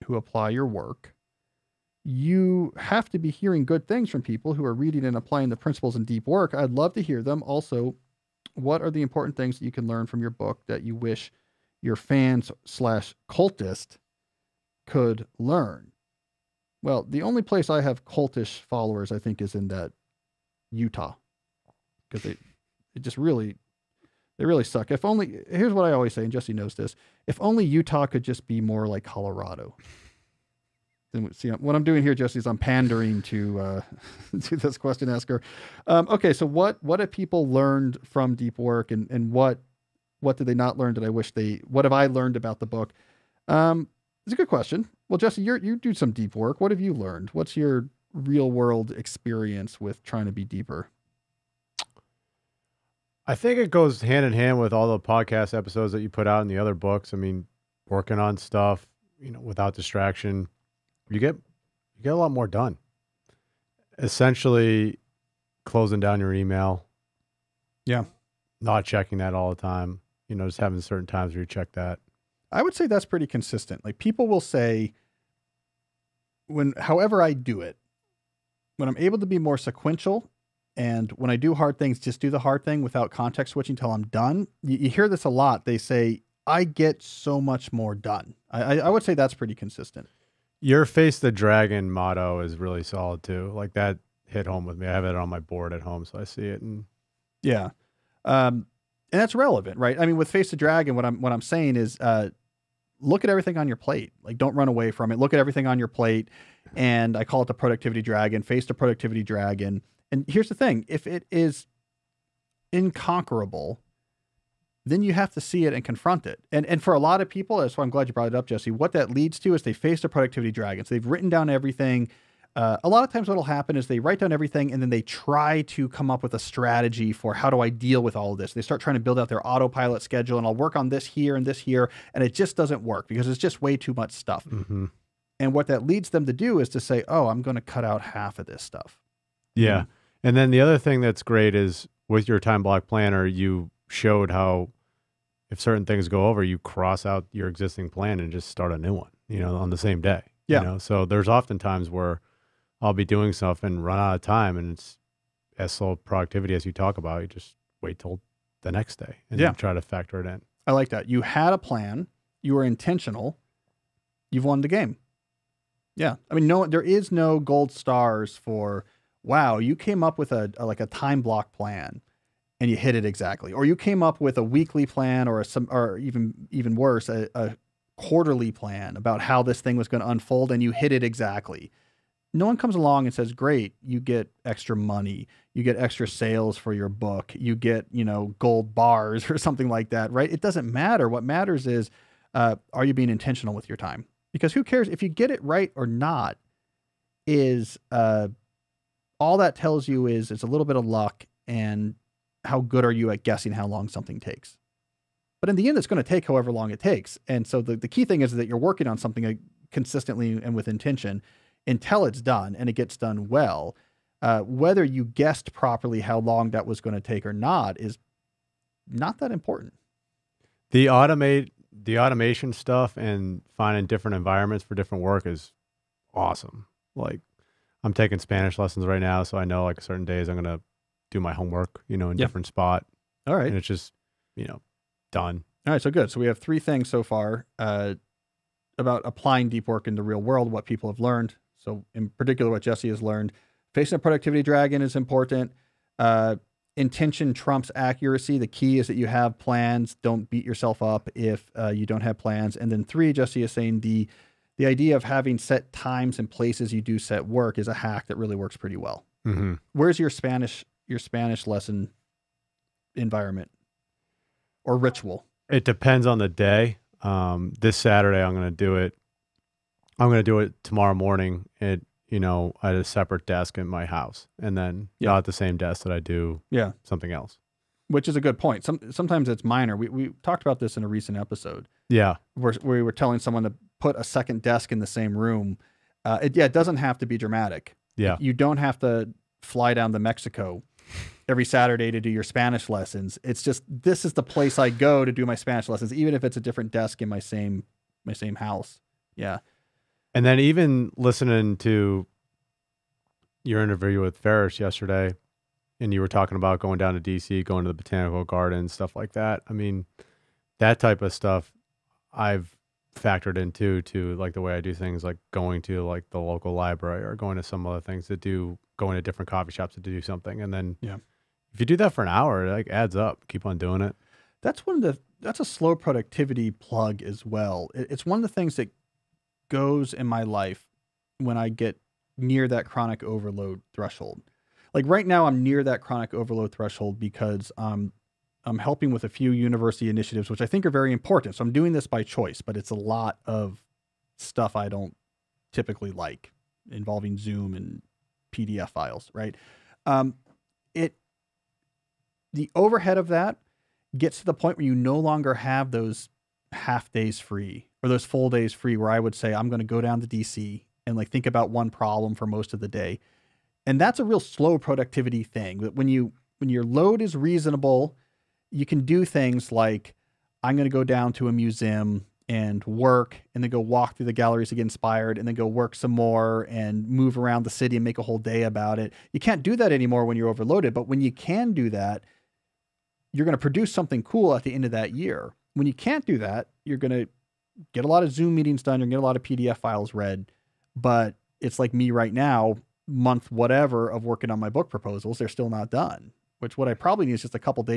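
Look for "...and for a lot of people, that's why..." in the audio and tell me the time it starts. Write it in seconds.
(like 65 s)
116 s.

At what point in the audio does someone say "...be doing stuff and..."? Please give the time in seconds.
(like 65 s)
152 s.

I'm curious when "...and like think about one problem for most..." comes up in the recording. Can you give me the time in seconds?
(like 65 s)
360 s.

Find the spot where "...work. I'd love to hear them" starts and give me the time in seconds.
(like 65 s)
6 s.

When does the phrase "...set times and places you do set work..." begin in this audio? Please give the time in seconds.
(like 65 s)
255 s.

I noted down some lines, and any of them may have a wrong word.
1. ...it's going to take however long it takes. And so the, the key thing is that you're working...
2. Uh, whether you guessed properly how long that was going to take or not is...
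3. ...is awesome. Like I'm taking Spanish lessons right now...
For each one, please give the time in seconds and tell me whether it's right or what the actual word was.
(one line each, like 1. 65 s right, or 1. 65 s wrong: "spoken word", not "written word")
1. 205 s right
2. 214 s right
3. 225 s right.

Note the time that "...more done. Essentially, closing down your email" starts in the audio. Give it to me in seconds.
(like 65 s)
62 s.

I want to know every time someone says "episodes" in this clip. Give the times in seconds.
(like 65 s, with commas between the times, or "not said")
55 s, 281 s.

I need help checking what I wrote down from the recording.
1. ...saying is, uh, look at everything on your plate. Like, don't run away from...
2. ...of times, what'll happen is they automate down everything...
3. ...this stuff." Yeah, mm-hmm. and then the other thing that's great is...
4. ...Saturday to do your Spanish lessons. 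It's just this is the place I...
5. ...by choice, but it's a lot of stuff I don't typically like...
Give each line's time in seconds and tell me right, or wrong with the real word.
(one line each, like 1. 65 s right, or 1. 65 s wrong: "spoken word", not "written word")
1. 101 s right
2. 123 s wrong: "write", not "automate"
3. 138 s right
4. 291 s right
5. 341 s right.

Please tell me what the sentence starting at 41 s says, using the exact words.
What have I learned about the book?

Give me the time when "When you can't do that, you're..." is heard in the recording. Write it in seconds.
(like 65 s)
385 s.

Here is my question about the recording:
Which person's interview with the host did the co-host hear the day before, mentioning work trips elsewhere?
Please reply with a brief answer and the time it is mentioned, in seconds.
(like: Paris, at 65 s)
Ferriss, at 304 s.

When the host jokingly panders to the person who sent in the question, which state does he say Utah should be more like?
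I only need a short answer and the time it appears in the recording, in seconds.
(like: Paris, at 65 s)
Colorado, at 29 s.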